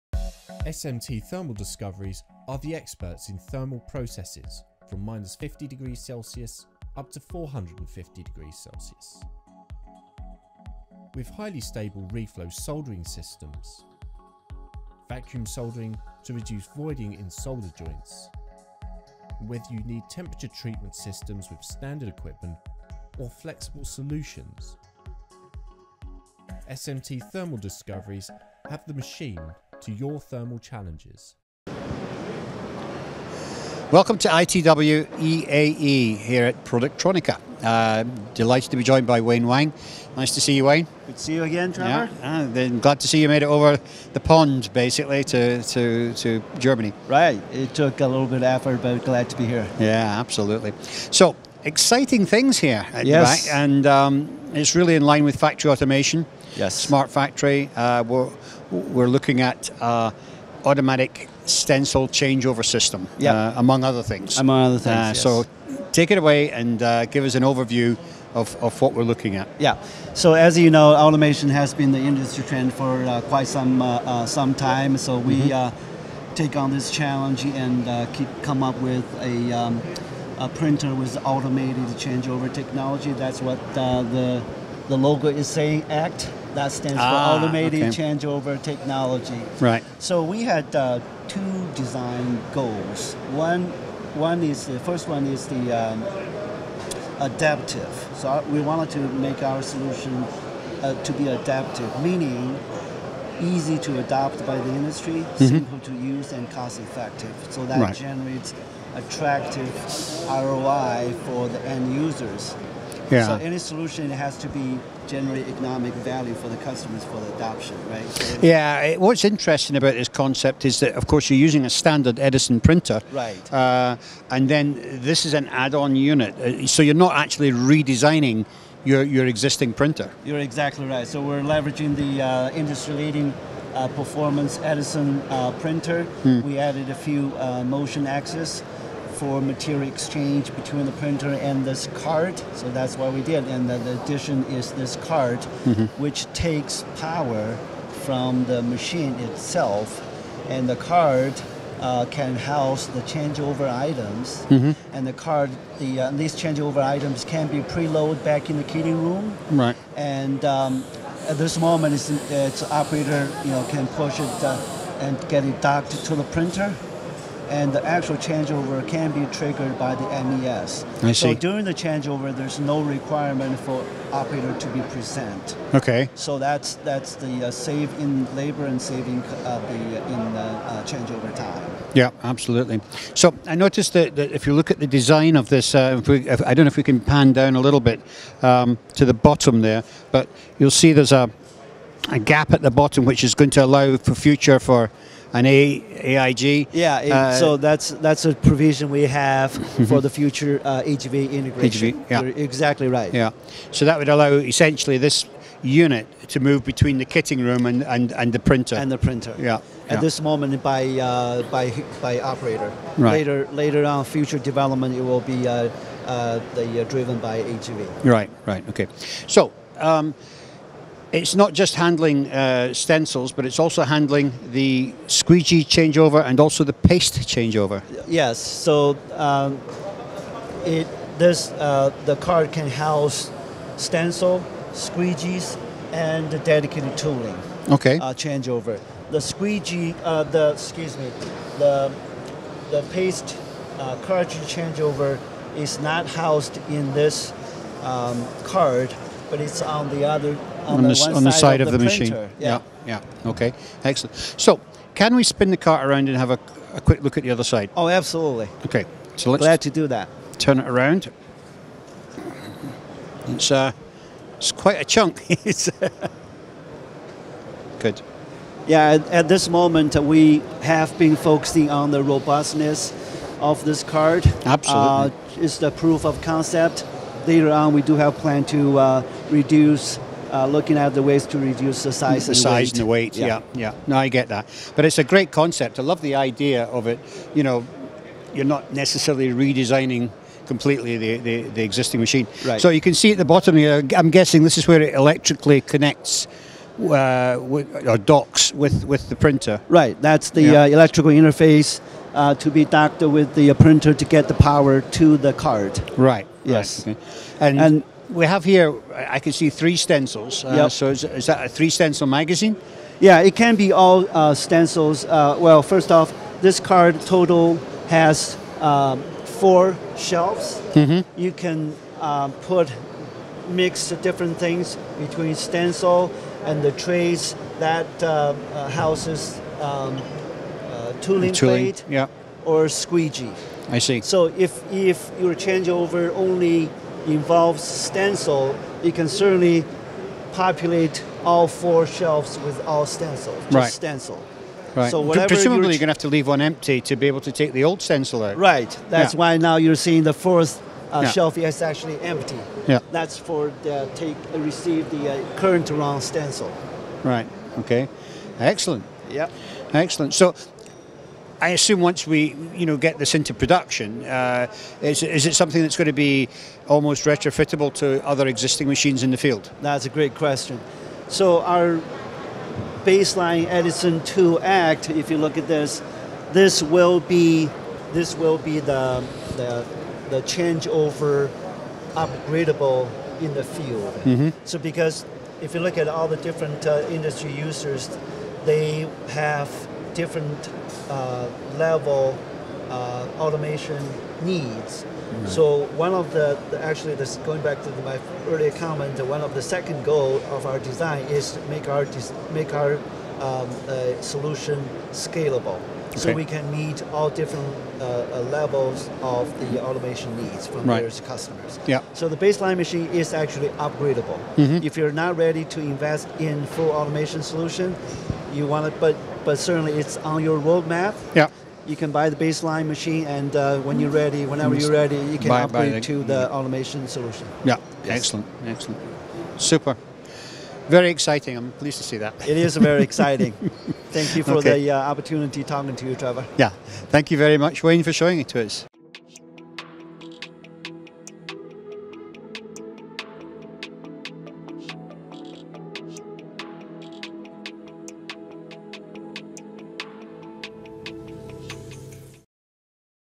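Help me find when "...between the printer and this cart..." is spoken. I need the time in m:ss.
2:20.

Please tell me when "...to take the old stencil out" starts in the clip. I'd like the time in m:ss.
5:47.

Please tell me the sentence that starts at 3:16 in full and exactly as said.
Yeah, it, uh, so that's that's a provision we have mm-hmm.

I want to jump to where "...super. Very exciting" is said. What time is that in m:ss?
7:09.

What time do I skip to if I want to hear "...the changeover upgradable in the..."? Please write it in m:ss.
6:20.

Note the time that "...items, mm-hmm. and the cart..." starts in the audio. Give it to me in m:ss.
2:33.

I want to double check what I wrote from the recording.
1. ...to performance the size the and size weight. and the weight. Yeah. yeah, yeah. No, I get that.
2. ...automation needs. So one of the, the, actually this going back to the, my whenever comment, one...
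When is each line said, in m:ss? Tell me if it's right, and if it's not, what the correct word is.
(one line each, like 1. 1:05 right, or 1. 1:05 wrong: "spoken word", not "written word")
1. 4:41 wrong: "reduce", not "performance"
2. 6:33 wrong: "earlier", not "whenever".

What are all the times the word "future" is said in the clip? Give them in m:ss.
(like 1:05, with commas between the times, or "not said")
3:14, 3:20, 3:34.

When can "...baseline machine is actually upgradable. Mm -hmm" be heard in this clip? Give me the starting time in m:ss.
6:52.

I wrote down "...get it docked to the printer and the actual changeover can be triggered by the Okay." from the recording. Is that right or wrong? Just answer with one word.
wrong.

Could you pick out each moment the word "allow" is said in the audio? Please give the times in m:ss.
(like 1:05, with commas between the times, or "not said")
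3:13, 3:24.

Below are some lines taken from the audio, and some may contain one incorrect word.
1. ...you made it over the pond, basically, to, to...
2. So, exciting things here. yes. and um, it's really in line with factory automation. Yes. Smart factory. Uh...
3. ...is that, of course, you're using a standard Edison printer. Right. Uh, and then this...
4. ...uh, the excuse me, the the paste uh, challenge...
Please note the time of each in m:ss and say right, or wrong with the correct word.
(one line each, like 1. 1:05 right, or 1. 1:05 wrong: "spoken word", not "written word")
1. 0:43 right
2. 0:50 right
3. 2:00 right
4. 4:00 wrong: "cartridge", not "challenge".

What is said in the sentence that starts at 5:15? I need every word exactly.
Uh, well, first off, this card total has um, four shelves.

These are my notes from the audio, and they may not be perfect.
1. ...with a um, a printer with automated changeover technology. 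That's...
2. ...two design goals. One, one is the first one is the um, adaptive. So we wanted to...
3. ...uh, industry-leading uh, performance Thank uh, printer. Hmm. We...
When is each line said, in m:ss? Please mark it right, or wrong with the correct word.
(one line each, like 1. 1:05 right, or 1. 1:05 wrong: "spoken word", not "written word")
1. 1:18 right
2. 1:31 right
3. 2:12 wrong: "Edison", not "Thank".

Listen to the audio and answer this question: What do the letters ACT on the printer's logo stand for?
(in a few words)
Automated Changeover Technology.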